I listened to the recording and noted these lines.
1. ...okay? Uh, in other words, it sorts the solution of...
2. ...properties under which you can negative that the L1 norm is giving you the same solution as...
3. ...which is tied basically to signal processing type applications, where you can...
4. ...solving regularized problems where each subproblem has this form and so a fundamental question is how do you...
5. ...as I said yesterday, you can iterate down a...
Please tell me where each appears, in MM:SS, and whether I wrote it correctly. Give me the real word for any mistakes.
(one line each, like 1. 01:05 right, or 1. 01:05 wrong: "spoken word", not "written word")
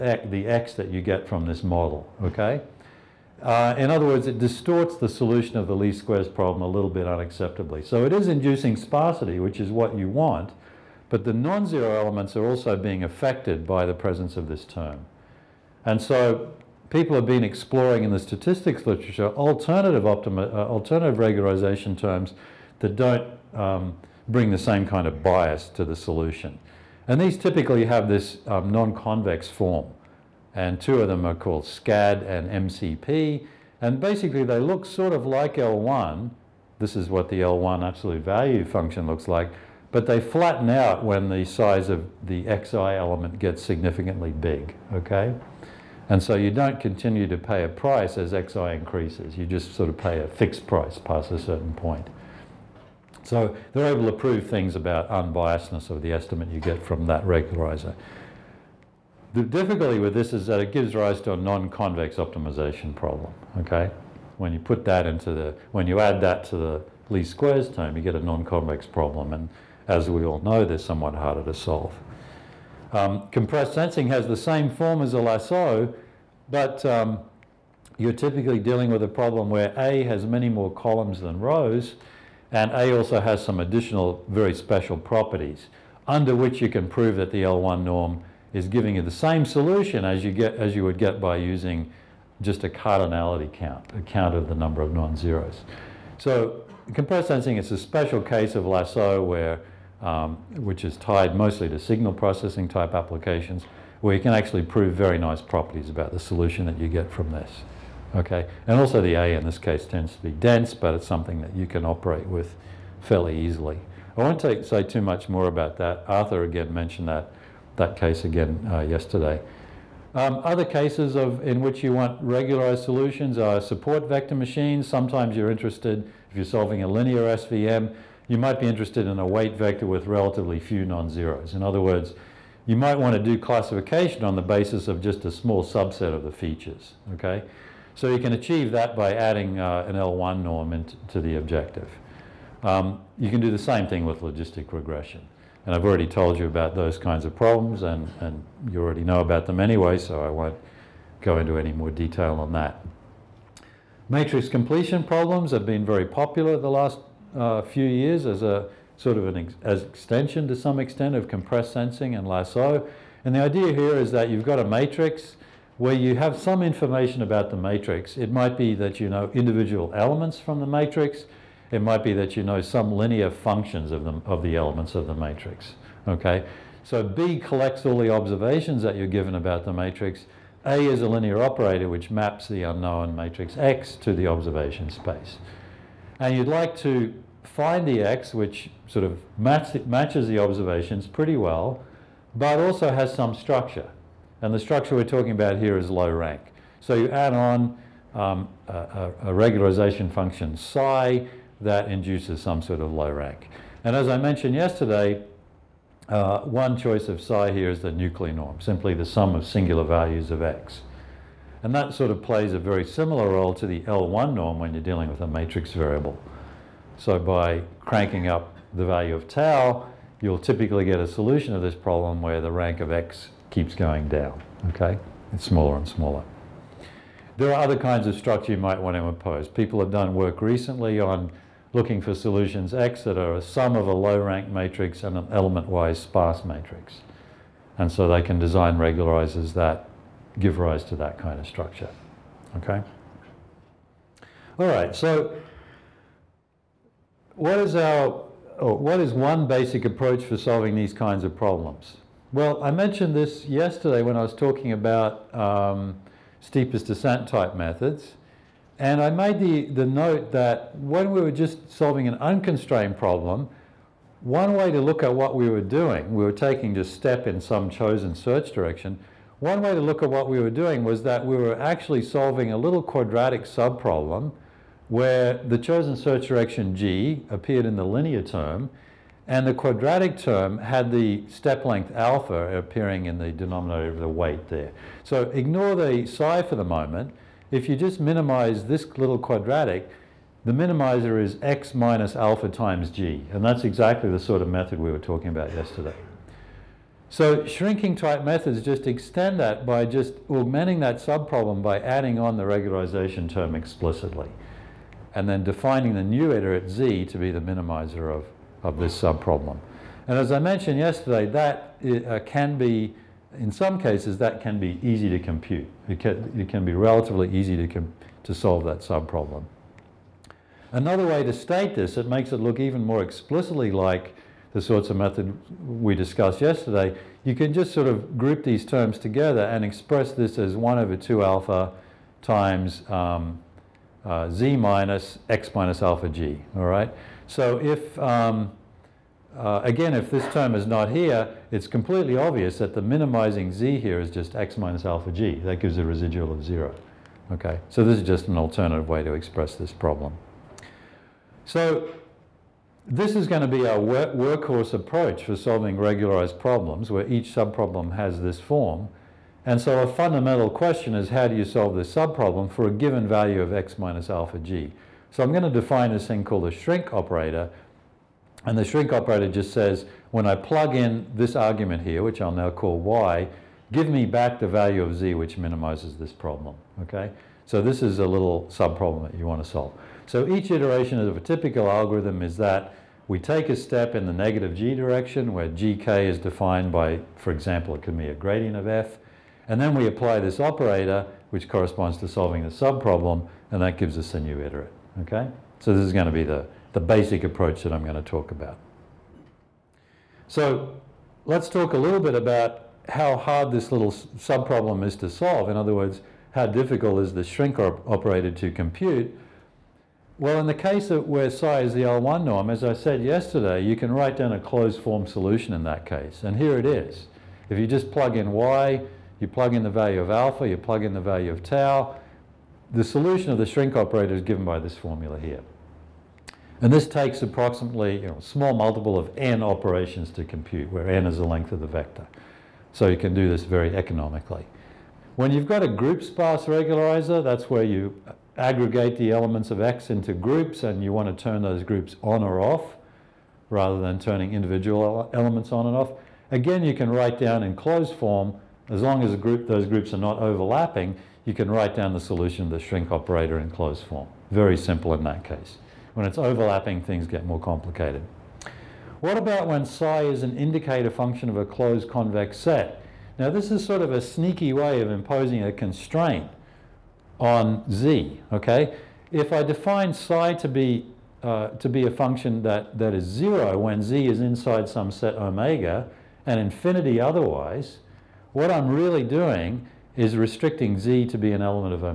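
1. 00:02 wrong: "distorts", not "sorts"
2. 01:24 wrong: "prove", not "negative"
3. 01:40 wrong: "mostly", not "basically"
4. 05:55 right
5. 06:52 wrong: "write", not "iterate".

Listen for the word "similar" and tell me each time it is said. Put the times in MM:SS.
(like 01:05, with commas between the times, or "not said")
03:32.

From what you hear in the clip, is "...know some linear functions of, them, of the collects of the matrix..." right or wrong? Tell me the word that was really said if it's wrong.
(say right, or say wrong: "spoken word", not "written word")
wrong: "elements", not "collects".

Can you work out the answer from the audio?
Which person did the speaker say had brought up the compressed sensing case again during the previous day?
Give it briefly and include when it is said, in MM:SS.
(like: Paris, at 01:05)
Arthur, at 01:56.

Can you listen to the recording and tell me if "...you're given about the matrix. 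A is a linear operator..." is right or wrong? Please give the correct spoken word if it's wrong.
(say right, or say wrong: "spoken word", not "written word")
right.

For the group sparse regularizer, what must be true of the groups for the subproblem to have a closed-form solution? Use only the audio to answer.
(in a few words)
not overlapping.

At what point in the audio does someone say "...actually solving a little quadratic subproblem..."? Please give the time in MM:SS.
04:31.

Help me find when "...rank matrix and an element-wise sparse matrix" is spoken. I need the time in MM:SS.
03:54.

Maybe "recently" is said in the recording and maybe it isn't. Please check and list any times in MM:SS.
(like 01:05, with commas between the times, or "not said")
03:50.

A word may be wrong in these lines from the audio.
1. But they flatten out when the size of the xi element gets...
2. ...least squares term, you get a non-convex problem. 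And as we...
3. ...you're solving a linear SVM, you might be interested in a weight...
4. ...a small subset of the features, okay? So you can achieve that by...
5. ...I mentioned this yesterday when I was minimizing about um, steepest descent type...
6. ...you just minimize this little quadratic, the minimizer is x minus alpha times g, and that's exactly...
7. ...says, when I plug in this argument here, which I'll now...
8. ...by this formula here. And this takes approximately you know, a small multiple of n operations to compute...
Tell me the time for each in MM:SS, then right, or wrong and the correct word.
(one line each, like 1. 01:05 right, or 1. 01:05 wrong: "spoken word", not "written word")
1. 00:39 right
2. 01:07 right
3. 02:06 right
4. 02:15 right
5. 04:12 wrong: "talking", not "minimizing"
6. 04:47 right
7. 06:09 right
8. 07:04 right.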